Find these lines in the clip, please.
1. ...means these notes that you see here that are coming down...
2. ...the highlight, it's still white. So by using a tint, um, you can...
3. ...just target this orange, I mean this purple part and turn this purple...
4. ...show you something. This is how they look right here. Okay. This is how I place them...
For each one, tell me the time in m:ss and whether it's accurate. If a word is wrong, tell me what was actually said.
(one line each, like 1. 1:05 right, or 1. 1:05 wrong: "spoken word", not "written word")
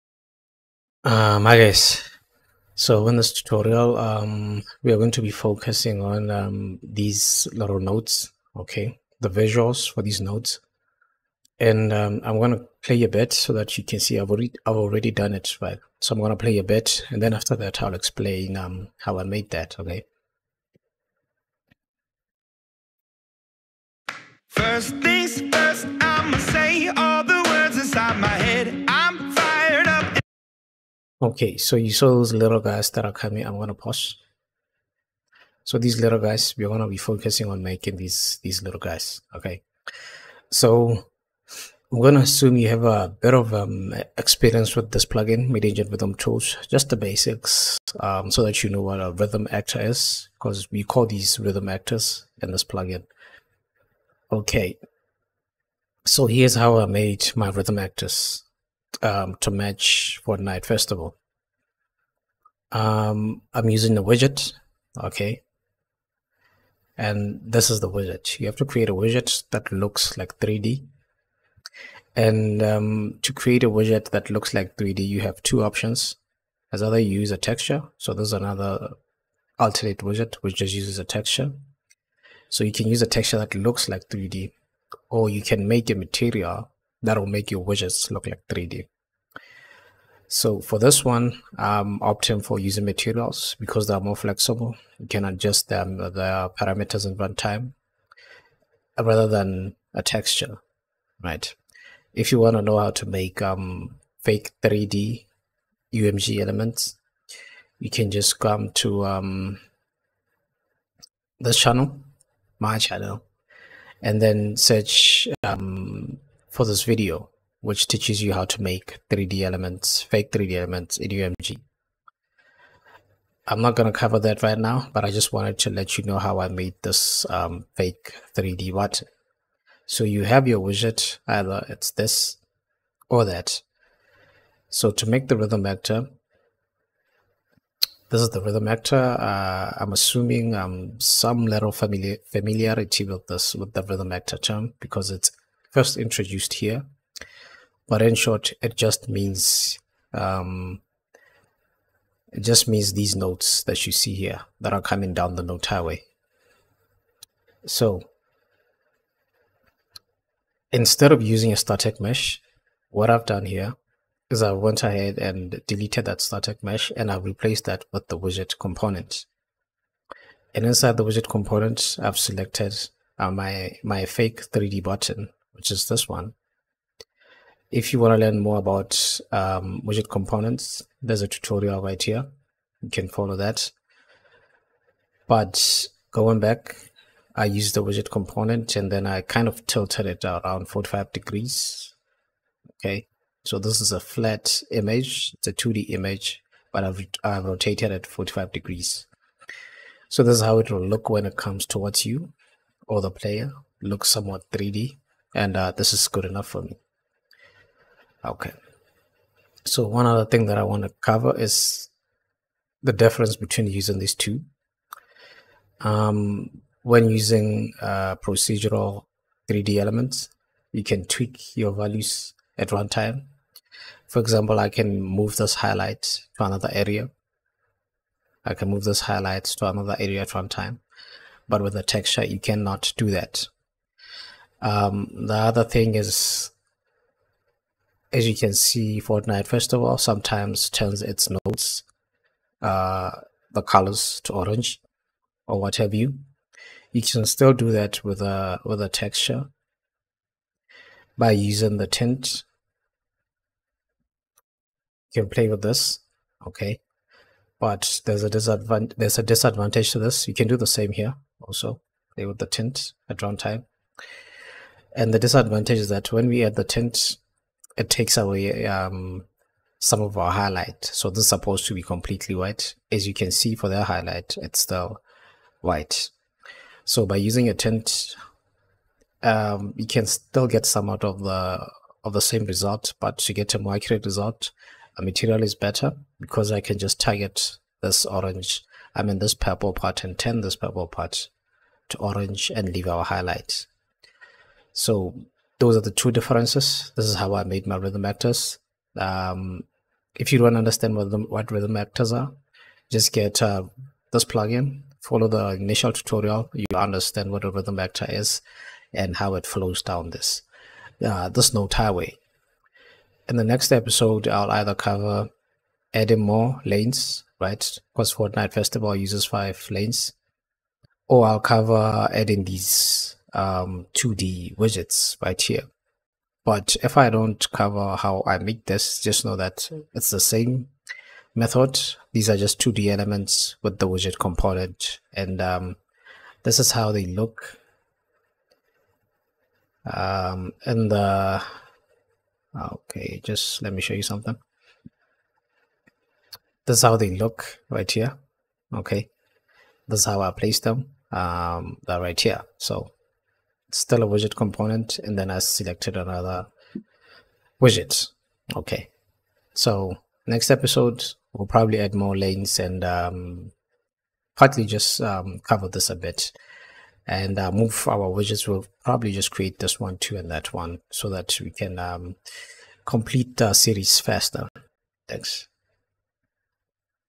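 1. 2:32 right
2. 4:33 right
3. 4:46 right
4. 5:43 right.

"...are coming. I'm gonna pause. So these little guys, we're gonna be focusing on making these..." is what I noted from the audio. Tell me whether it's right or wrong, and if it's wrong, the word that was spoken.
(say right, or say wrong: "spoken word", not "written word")
right.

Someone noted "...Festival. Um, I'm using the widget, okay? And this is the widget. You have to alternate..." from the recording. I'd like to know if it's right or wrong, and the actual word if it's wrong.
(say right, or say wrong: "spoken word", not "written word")
wrong: "create", not "alternate".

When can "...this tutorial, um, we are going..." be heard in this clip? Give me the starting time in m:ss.
0:03.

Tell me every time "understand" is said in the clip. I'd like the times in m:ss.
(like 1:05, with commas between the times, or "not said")
5:00, 5:06.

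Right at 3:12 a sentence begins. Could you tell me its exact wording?
Okay, so this is a flat image, it's a 2D image, but I've, I've rotated it 45 degrees.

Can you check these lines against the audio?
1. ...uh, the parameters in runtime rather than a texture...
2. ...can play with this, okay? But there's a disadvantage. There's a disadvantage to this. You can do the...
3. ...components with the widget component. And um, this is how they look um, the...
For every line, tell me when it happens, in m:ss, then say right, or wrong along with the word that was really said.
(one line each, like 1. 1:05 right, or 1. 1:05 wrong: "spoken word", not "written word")
1. 1:35 right
2. 4:15 right
3. 5:32 wrong: "elements", not "components".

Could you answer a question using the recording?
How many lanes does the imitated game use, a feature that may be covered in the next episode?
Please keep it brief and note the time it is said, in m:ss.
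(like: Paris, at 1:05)
5, at 5:19.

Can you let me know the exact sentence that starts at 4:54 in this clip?
So those are the two differences.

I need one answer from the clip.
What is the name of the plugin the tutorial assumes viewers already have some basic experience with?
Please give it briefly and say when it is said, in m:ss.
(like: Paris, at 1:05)
MIDI Engine rhythm tools, at 0:45.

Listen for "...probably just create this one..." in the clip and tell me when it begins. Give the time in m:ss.
6:08.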